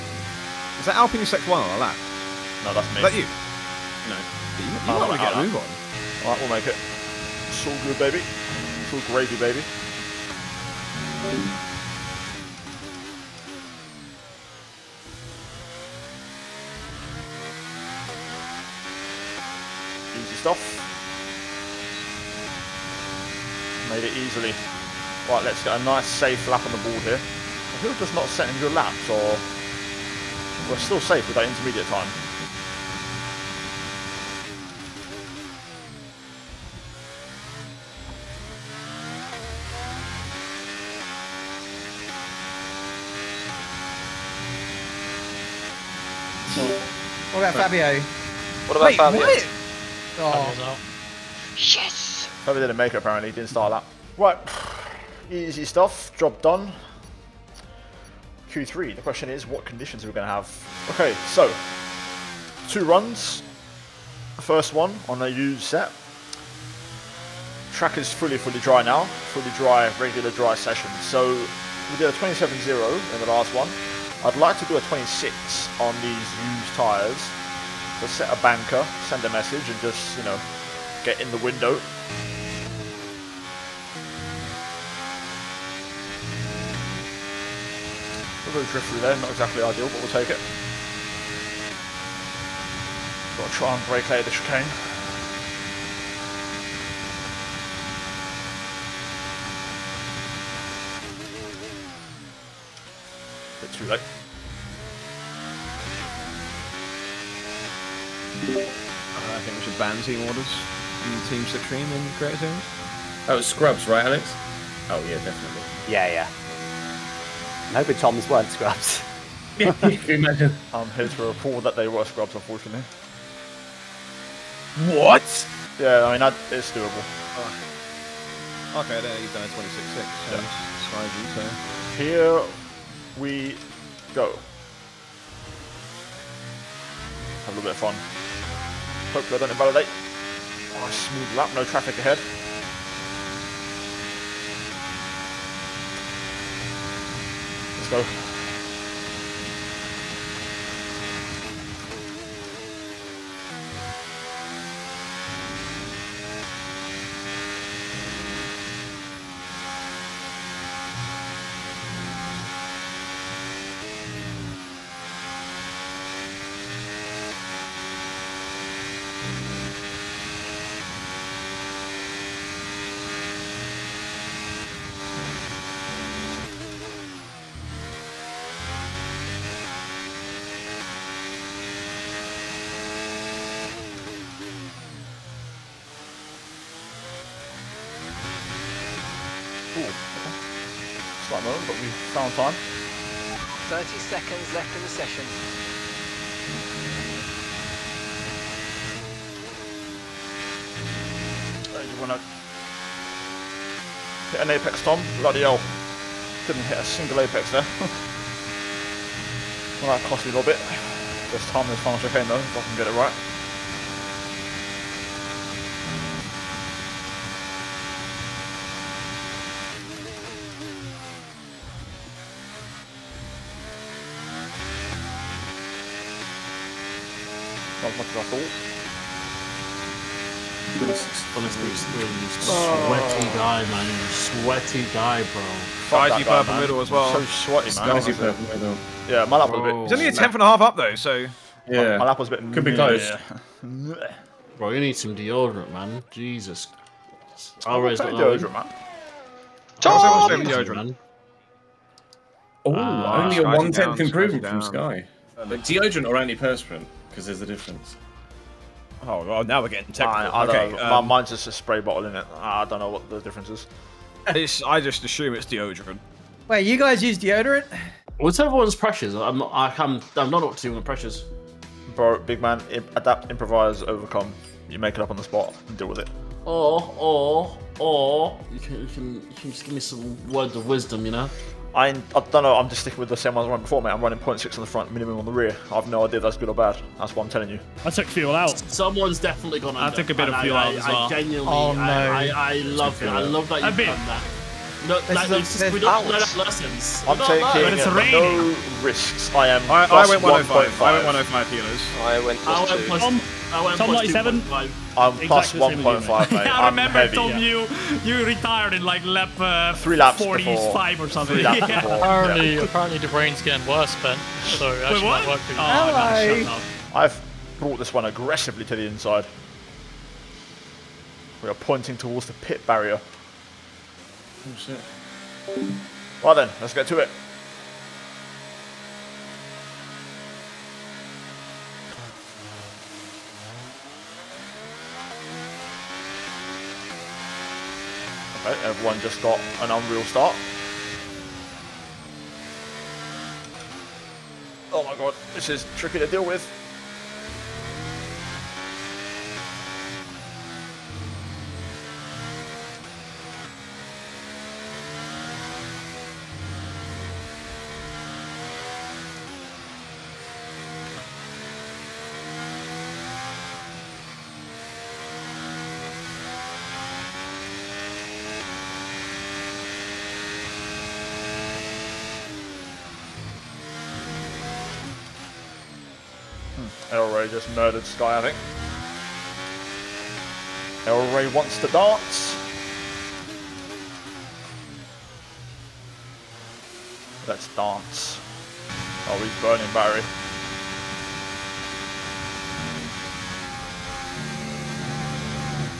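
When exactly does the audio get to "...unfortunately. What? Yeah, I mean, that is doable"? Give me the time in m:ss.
2:02.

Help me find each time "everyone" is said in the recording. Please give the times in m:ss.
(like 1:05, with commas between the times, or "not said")
4:28, 5:38.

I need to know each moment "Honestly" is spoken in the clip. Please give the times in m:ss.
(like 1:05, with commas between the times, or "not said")
3:51, 3:57.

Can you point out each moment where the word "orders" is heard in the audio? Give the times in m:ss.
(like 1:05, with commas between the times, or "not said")
1:50.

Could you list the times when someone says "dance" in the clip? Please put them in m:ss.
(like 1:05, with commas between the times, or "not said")
6:21, 6:27.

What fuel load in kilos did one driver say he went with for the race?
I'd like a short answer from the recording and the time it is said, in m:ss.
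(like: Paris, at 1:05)
105 kilos, at 5:01.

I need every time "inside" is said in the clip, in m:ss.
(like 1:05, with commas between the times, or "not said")
5:18.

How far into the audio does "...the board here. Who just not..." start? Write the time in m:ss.
0:26.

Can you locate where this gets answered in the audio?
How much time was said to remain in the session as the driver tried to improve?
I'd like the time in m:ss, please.
3:13.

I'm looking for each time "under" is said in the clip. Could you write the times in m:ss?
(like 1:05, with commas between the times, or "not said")
4:49.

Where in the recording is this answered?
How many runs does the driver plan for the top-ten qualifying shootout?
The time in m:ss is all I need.
1:02.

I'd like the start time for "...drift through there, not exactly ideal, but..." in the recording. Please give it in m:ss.
1:28.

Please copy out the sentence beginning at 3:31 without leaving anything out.
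This time this final chicane though, if I can get it right.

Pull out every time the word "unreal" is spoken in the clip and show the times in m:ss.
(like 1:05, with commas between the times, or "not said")
5:39.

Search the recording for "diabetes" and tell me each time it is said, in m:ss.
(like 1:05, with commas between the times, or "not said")
not said.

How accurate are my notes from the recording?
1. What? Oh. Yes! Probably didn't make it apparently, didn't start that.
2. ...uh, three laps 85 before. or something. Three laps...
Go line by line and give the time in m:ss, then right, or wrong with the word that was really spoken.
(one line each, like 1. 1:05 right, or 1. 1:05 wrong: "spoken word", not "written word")
1. 0:49 right
2. 5:09 wrong: "45", not "85".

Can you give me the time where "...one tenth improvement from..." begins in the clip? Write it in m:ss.
4:13.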